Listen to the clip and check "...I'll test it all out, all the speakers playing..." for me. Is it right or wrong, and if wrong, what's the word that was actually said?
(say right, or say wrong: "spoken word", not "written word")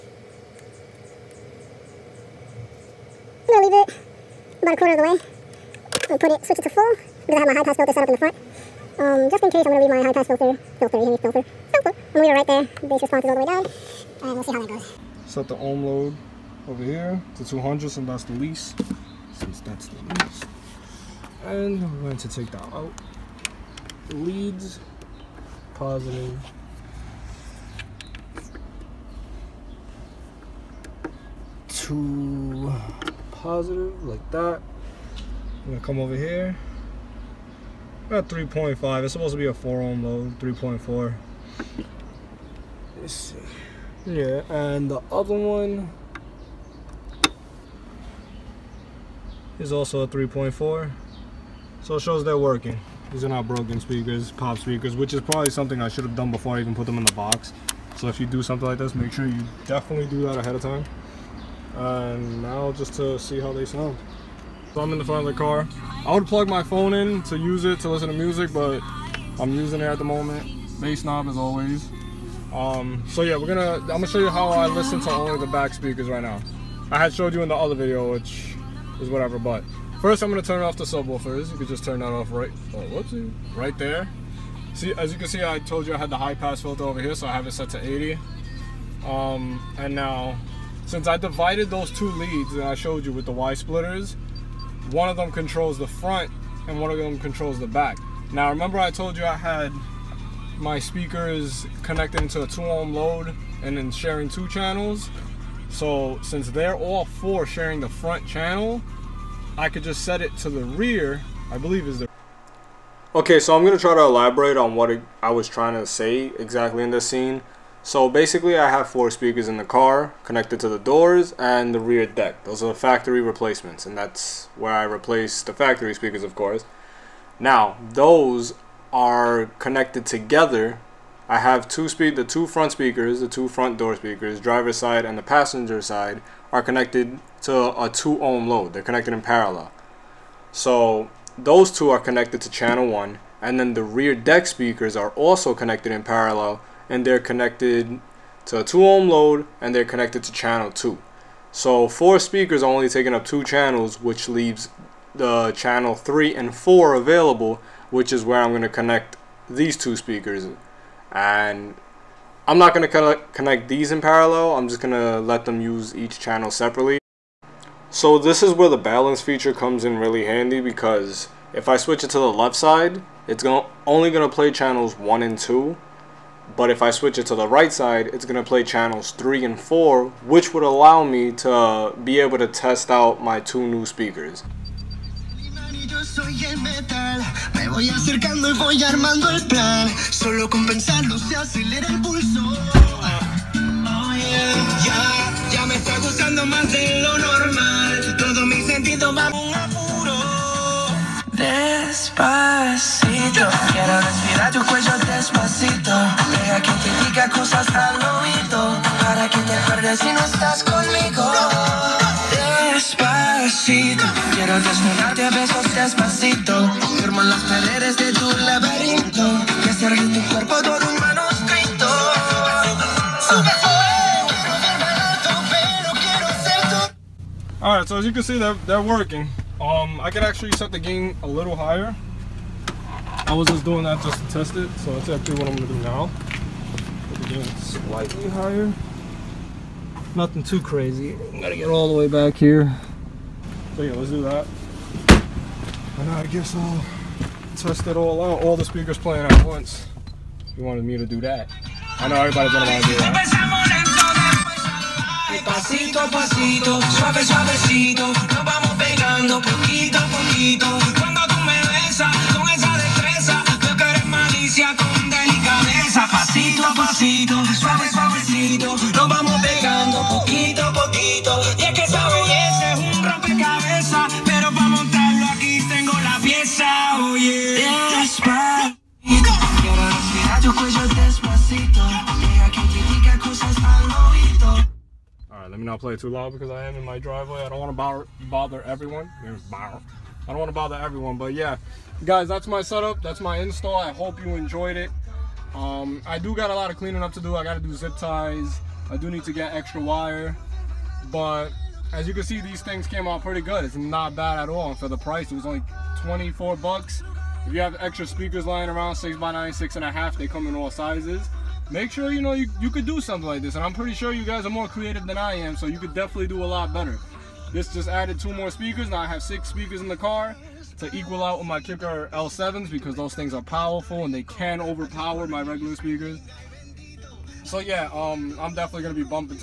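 right.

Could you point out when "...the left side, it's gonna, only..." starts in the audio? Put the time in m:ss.
2:52.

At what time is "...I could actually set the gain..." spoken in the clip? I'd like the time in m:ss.
3:49.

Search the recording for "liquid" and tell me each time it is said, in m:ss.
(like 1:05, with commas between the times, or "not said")
not said.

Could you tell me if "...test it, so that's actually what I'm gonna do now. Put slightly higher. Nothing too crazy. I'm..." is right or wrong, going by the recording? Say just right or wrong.
right.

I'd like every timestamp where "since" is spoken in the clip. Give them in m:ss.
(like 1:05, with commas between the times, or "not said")
0:19, 1:30, 1:46.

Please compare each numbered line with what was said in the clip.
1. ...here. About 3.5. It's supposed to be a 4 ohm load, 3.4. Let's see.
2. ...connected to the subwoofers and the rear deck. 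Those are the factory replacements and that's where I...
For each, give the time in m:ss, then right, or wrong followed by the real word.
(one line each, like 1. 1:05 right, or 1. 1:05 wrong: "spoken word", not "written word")
1. 0:36 right
2. 2:00 wrong: "doors", not "subwoofers".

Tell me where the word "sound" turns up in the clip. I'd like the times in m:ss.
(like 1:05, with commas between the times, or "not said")
1:03.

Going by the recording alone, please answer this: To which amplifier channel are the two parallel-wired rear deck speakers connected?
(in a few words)
channel 2.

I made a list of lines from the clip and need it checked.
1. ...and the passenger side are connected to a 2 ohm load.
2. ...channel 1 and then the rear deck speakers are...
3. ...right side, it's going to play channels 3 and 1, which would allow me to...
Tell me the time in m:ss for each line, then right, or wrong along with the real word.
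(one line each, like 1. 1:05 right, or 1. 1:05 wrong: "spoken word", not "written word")
1. 2:15 right
2. 2:22 right
3. 2:57 wrong: "4", not "1".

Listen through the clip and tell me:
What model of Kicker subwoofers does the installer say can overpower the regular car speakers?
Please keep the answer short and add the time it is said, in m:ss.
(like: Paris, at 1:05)
L7s, at 5:22.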